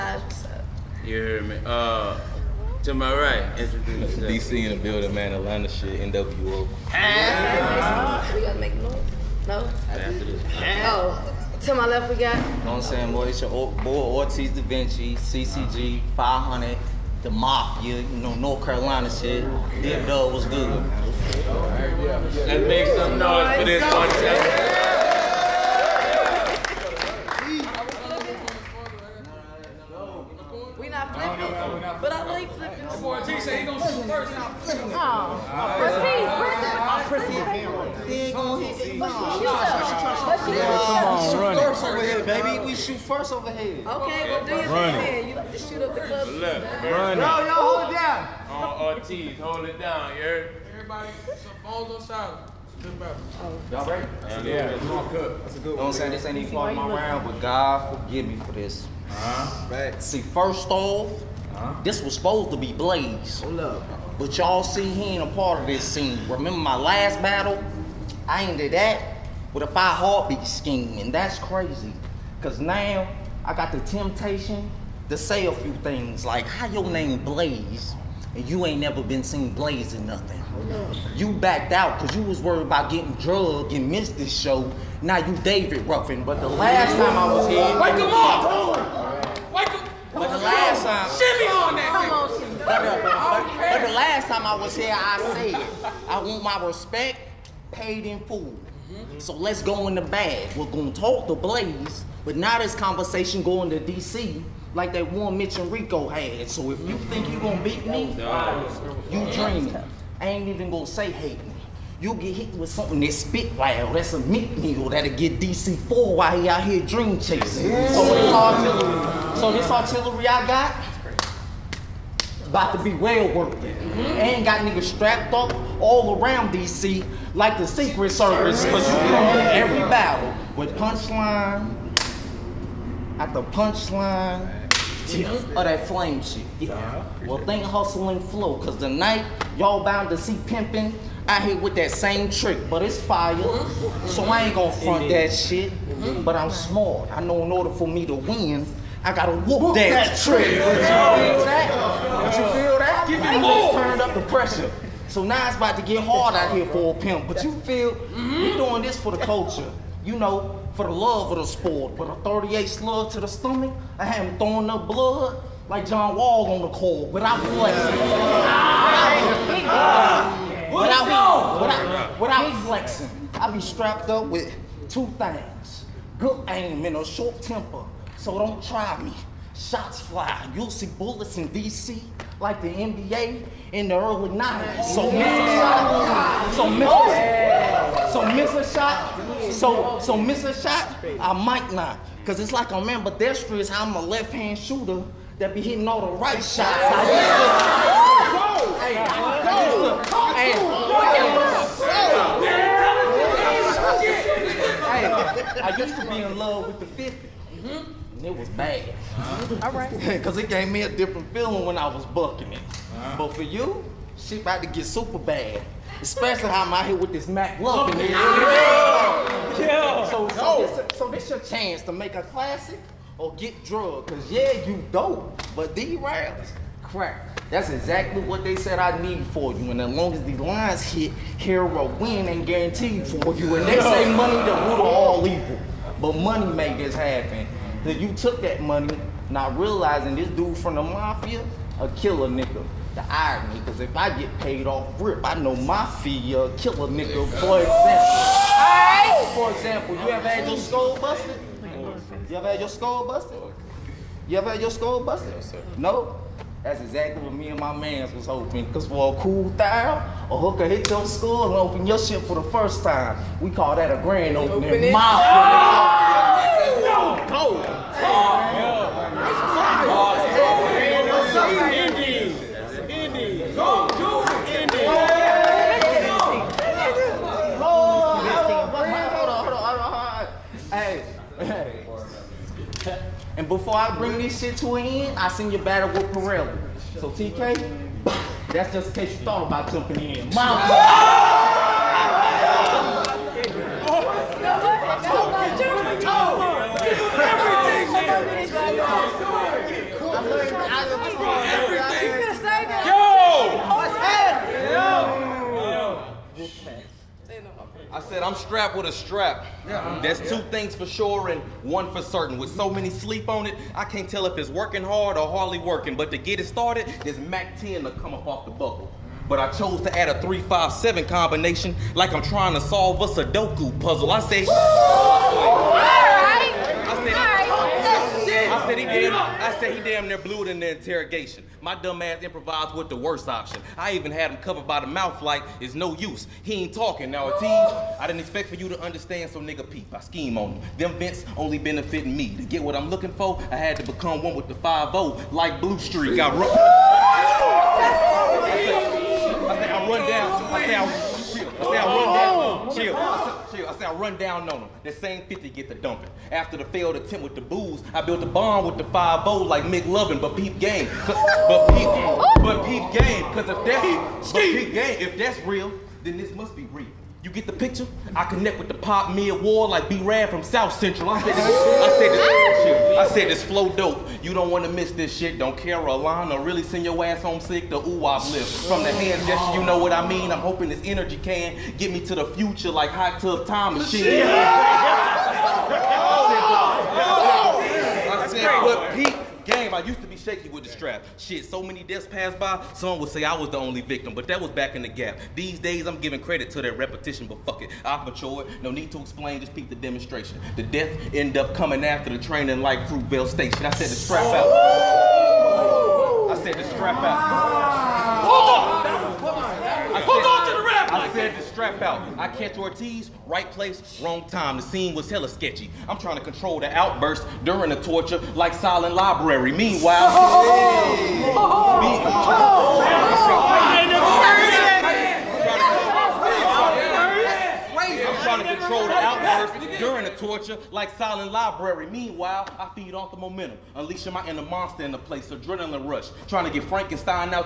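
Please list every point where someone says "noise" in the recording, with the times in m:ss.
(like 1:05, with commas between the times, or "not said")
0:08, 0:23.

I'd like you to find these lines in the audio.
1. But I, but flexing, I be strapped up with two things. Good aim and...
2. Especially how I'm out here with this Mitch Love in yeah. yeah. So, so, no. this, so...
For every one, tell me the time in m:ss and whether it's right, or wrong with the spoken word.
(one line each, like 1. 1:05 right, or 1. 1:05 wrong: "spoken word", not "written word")
1. 2:50 right
2. 3:36 wrong: "Mac", not "Mitch".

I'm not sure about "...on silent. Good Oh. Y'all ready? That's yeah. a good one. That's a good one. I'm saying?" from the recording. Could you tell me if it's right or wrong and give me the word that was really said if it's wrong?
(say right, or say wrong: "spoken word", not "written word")
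right.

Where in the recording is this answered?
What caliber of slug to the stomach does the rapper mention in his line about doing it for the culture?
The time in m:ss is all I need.
2:42.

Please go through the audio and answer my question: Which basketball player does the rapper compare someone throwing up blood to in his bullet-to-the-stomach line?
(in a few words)
John Wall.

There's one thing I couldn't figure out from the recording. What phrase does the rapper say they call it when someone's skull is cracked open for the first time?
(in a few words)
grand opening.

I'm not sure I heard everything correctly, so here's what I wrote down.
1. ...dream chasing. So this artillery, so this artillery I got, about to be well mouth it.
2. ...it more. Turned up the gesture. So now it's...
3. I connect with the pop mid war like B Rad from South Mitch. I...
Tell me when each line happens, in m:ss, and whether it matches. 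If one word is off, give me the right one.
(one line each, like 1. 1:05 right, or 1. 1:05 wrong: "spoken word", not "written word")
1. 1:56 wrong: "worth", not "mouth"
2. 2:33 wrong: "pressure", not "gesture"
3. 6:08 wrong: "Central", not "Mitch".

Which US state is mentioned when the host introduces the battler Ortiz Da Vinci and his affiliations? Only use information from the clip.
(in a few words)
North Carolina.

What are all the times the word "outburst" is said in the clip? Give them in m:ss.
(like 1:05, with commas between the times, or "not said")
6:56.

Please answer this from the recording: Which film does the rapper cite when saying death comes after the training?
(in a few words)
Fruitvale Station.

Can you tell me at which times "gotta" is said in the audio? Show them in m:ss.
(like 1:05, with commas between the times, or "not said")
0:08, 2:29.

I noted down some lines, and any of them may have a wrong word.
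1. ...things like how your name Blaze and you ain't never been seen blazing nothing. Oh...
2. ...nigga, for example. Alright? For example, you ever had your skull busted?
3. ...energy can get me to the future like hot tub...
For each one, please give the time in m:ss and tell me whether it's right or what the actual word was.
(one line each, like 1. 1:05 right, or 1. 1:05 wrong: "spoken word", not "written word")
1. 1:15 right
2. 4:06 right
3. 6:20 right.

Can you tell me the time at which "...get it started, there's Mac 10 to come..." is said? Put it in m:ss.
5:16.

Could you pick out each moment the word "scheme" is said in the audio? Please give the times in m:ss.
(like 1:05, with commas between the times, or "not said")
1:10, 5:40.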